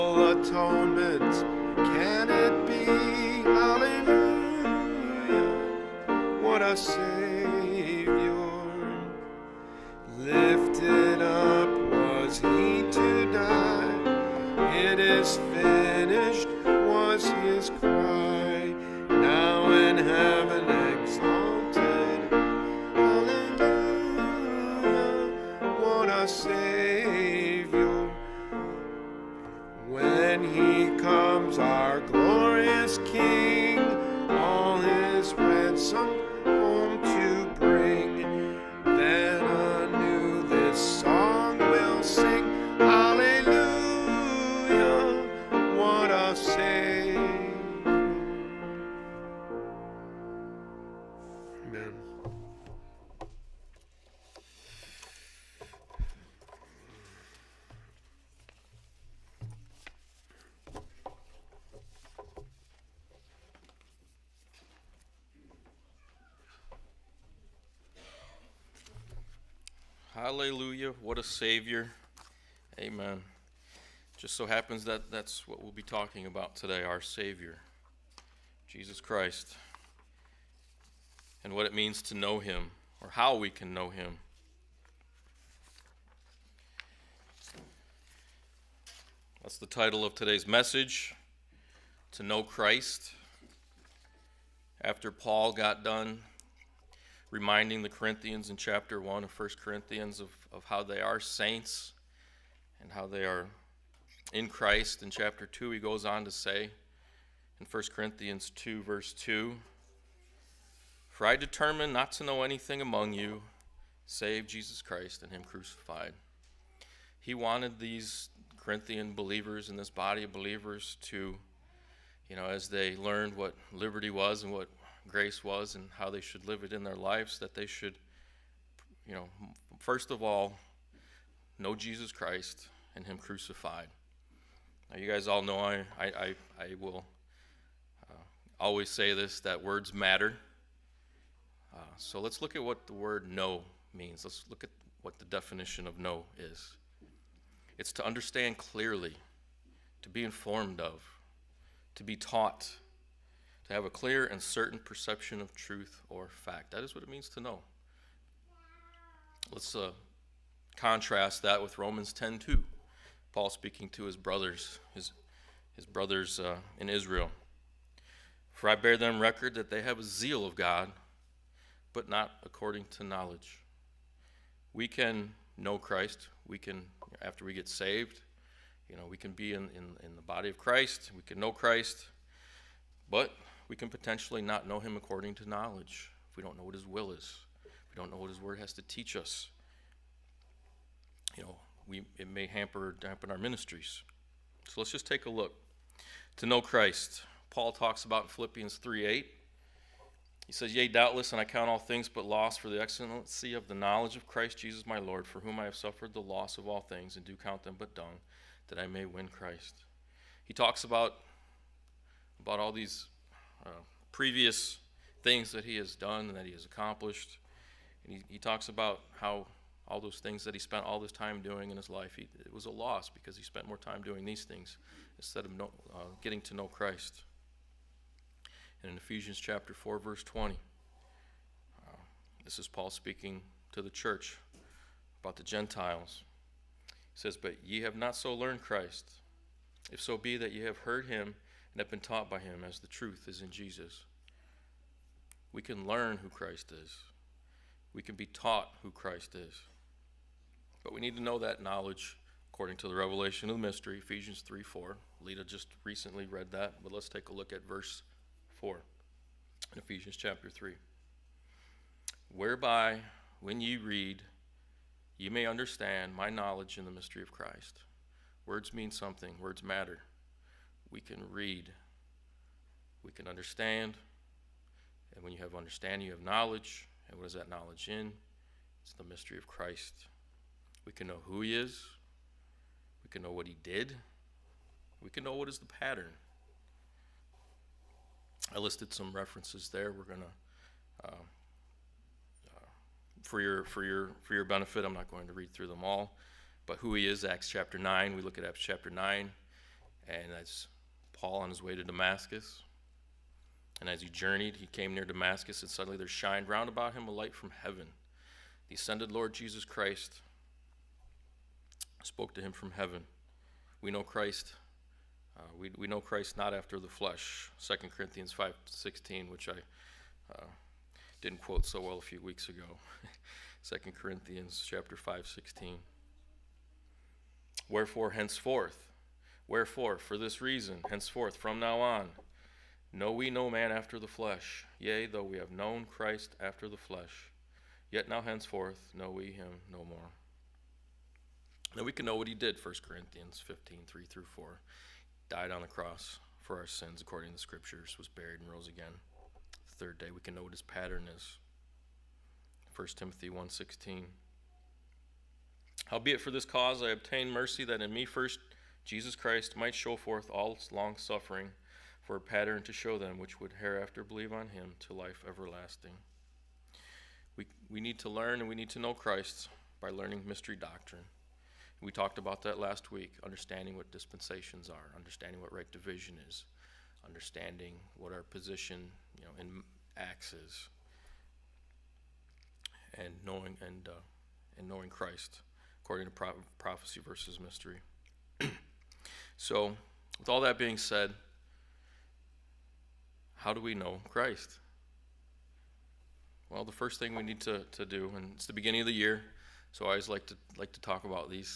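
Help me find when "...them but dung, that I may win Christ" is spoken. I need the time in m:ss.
3:27.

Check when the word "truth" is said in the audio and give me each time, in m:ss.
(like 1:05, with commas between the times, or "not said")
2:35, 4:02.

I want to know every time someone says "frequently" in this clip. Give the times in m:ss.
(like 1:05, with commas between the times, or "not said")
not said.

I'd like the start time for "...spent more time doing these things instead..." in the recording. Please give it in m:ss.
3:43.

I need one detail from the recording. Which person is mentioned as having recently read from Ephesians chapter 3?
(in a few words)
Lita.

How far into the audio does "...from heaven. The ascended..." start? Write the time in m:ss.
5:07.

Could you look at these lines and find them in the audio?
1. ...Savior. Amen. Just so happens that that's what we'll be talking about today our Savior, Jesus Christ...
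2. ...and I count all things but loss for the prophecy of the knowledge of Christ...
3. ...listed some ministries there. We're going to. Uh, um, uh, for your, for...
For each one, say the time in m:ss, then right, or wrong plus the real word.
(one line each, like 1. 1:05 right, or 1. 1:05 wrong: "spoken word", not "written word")
1. 1:11 right
2. 3:21 wrong: "excellency", not "prophecy"
3. 4:48 wrong: "references", not "ministries".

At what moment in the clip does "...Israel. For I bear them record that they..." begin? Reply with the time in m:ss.
2:46.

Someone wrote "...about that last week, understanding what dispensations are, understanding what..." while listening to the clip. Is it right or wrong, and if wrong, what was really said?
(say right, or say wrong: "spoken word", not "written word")
right.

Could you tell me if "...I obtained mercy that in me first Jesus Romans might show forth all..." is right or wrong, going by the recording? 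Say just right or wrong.
wrong.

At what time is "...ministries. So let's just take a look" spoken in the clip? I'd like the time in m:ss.
3:13.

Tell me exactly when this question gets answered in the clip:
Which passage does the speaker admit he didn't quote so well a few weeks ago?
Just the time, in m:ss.
5:17.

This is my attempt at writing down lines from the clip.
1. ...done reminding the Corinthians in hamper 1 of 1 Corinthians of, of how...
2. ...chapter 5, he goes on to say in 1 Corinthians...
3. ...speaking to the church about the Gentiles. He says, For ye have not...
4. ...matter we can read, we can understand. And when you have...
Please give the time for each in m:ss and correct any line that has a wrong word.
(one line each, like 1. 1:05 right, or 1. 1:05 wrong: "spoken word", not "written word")
1. 1:35 wrong: "chapter", not "hamper"
2. 1:45 wrong: "2", not "5"
3. 3:52 wrong: "But", not "For"
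4. 4:29 right.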